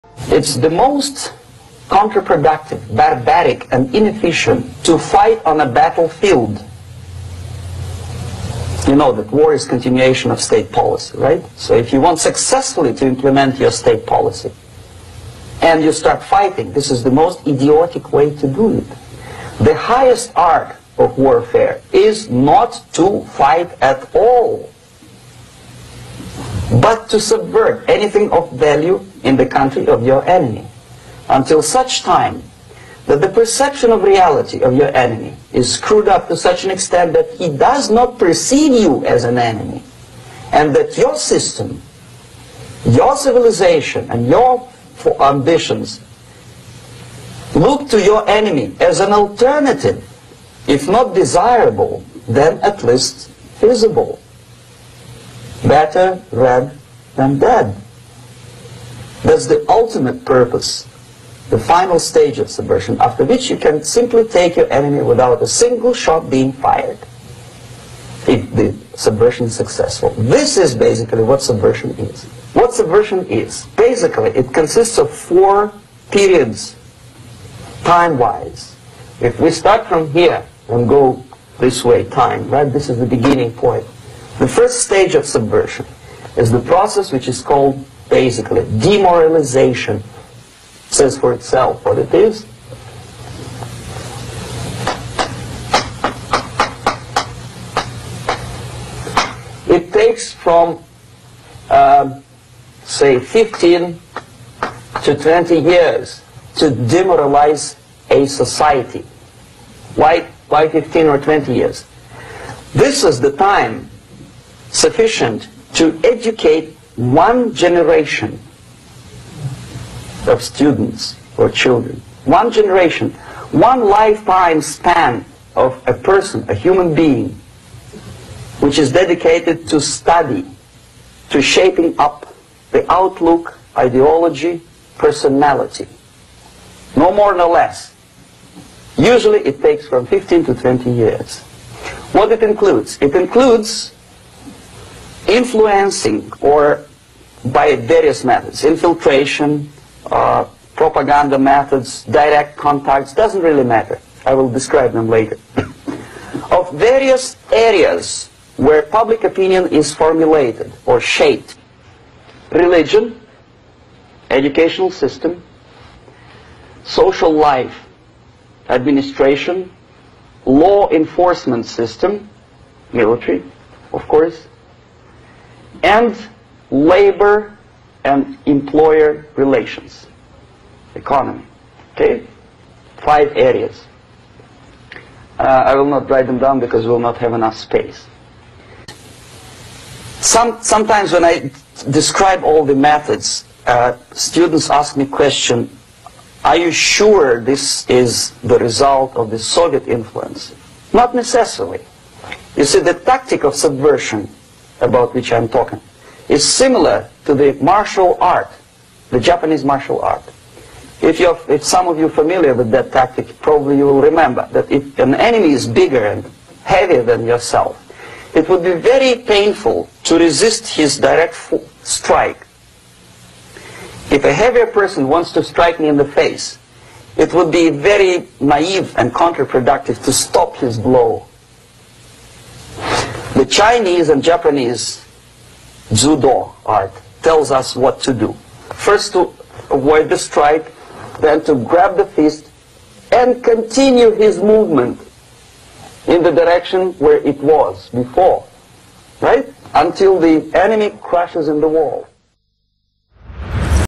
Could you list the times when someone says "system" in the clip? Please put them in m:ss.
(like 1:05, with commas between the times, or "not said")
0:41, 2:44, 2:51.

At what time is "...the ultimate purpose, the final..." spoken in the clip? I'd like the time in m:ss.
0:59.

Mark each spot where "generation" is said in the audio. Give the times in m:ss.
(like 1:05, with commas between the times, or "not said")
1:57, 2:02.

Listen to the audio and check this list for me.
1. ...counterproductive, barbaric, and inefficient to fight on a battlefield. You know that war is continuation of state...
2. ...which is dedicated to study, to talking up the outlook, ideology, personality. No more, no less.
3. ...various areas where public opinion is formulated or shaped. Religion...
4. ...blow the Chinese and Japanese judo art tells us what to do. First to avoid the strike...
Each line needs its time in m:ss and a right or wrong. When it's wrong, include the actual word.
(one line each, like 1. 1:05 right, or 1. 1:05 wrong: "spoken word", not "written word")
1. 0:01 right
2. 2:08 wrong: "shaping", not "talking"
3. 2:36 right
4. 3:50 right.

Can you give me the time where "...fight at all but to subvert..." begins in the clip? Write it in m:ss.
0:23.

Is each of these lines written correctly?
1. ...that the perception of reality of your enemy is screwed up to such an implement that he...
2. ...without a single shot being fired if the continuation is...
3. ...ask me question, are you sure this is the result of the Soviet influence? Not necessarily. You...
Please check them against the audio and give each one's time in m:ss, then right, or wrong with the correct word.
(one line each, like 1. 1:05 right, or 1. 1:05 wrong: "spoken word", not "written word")
1. 0:33 wrong: "extent", not "implement"
2. 1:05 wrong: "subversion", not "continuation"
3. 3:14 right.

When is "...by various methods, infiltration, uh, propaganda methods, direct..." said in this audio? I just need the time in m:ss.
2:27.